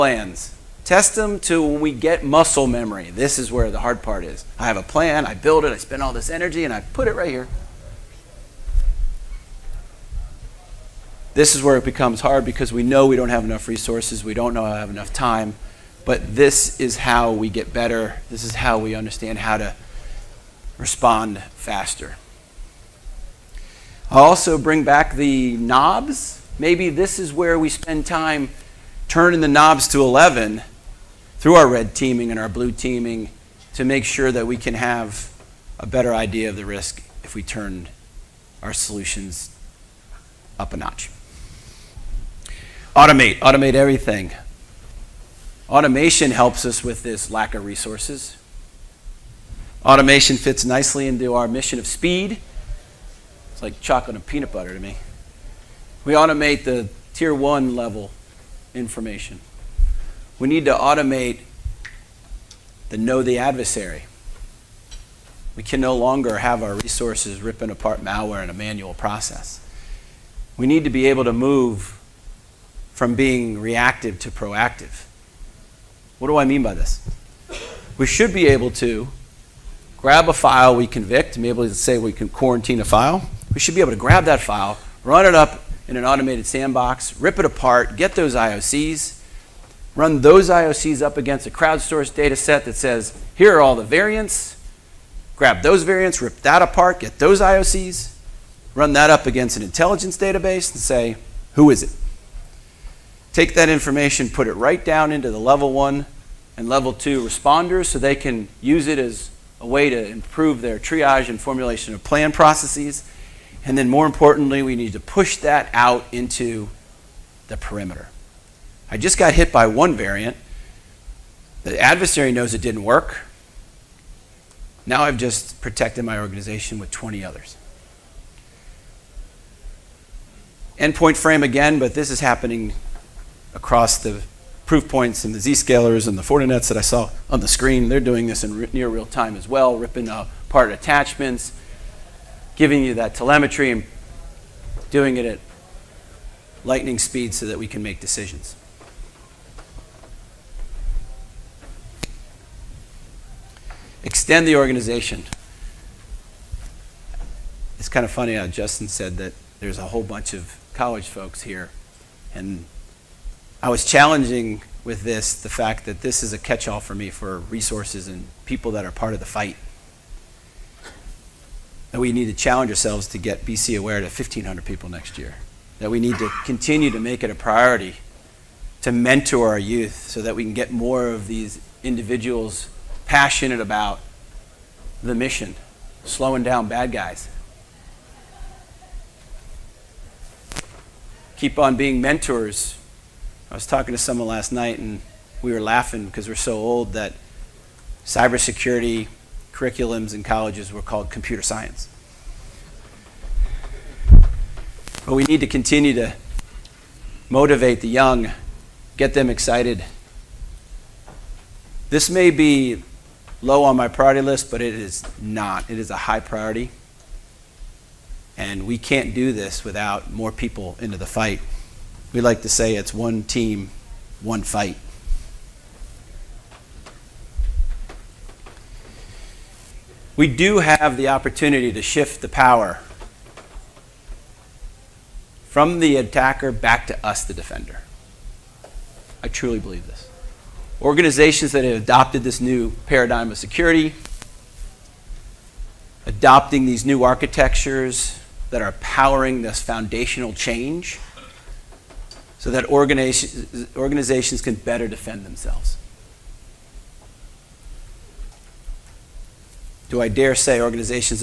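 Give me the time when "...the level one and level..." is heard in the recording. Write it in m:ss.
1:45.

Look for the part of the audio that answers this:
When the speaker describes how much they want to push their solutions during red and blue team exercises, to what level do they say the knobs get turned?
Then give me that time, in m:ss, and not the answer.
0:30.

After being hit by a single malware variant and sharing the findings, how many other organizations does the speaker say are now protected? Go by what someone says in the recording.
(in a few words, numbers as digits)
20.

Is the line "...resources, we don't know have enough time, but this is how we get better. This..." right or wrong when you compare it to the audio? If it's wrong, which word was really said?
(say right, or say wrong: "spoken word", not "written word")
right.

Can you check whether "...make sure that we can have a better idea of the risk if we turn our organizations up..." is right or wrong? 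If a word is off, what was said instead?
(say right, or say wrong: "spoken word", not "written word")
wrong: "solutions", not "organizations".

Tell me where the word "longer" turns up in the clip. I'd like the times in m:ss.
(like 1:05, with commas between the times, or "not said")
1:05.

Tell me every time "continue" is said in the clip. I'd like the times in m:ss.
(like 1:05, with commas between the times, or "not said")
2:56, 3:25.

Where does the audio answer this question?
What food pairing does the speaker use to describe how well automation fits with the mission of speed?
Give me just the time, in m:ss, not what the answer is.
0:53.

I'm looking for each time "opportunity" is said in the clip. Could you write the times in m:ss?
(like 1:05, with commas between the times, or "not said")
3:51.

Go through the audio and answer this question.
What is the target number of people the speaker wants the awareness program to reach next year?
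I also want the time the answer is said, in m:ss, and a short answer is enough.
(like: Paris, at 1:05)
1,500, at 2:54.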